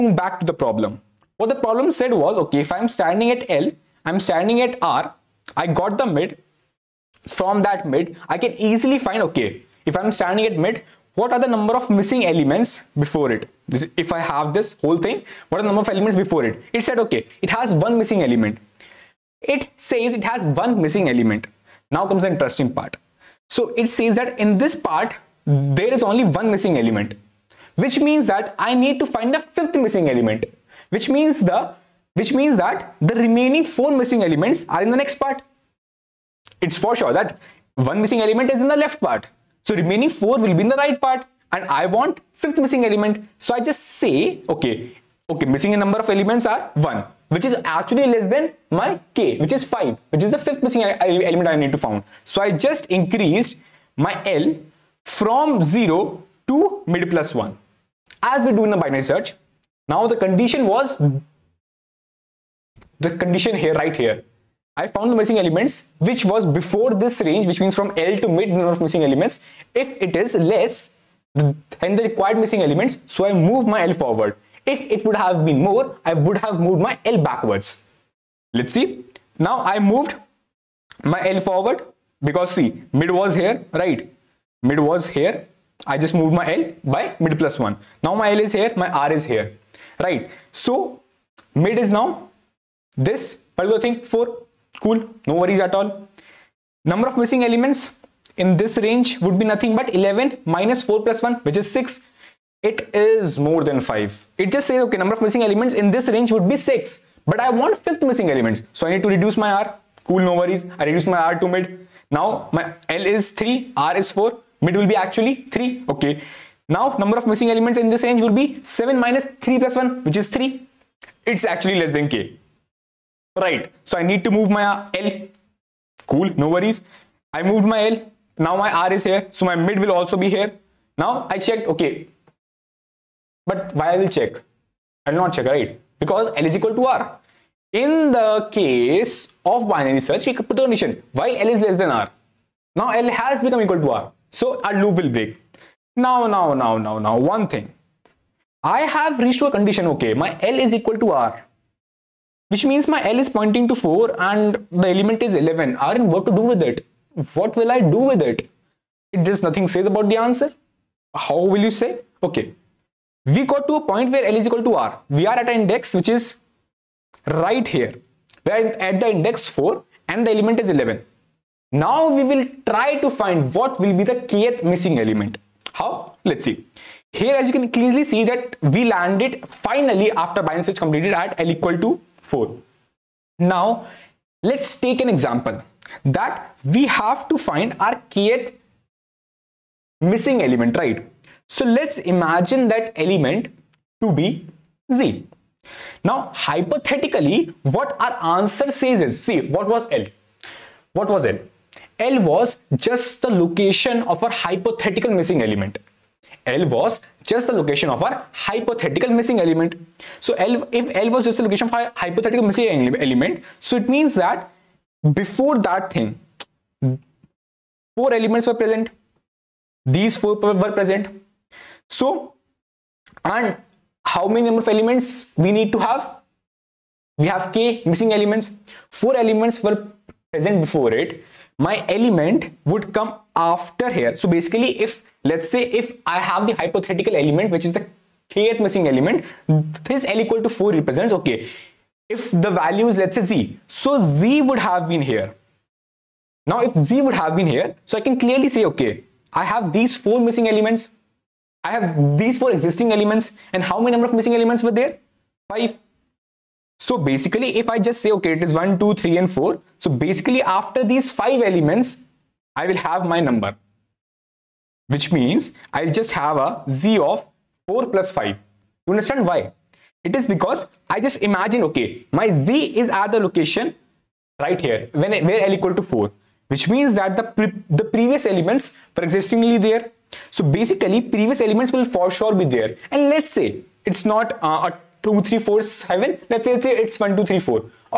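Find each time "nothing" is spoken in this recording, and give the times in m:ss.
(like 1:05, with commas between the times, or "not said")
1:39, 2:39.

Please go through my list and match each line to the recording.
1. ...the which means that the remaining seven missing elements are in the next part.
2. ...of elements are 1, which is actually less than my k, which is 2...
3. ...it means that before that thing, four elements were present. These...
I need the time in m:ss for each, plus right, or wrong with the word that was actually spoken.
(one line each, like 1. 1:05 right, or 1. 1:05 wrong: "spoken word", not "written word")
1. 0:31 wrong: "four", not "seven"
2. 0:46 wrong: "5", not "2"
3. 3:33 right.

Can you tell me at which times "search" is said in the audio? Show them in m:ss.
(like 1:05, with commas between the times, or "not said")
0:59, 2:20, 3:00.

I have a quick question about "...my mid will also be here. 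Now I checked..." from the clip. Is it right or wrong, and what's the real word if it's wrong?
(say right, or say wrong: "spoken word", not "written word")
right.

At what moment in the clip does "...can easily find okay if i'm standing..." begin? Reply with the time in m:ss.
0:08.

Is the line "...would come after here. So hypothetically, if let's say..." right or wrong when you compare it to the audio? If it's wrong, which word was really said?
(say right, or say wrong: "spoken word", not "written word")
wrong: "basically", not "hypothetically".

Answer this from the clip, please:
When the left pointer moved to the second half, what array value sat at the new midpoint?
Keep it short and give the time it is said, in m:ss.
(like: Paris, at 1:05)
4, at 1:33.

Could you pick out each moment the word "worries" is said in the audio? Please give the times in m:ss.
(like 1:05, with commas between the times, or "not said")
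1:35, 1:50, 2:06.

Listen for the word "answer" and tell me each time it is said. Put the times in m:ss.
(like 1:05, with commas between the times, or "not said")
2:40, 3:18.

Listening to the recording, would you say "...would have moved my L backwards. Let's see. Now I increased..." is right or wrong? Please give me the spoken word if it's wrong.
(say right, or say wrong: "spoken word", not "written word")
wrong: "moved", not "increased".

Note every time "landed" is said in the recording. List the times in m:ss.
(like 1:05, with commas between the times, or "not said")
2:58.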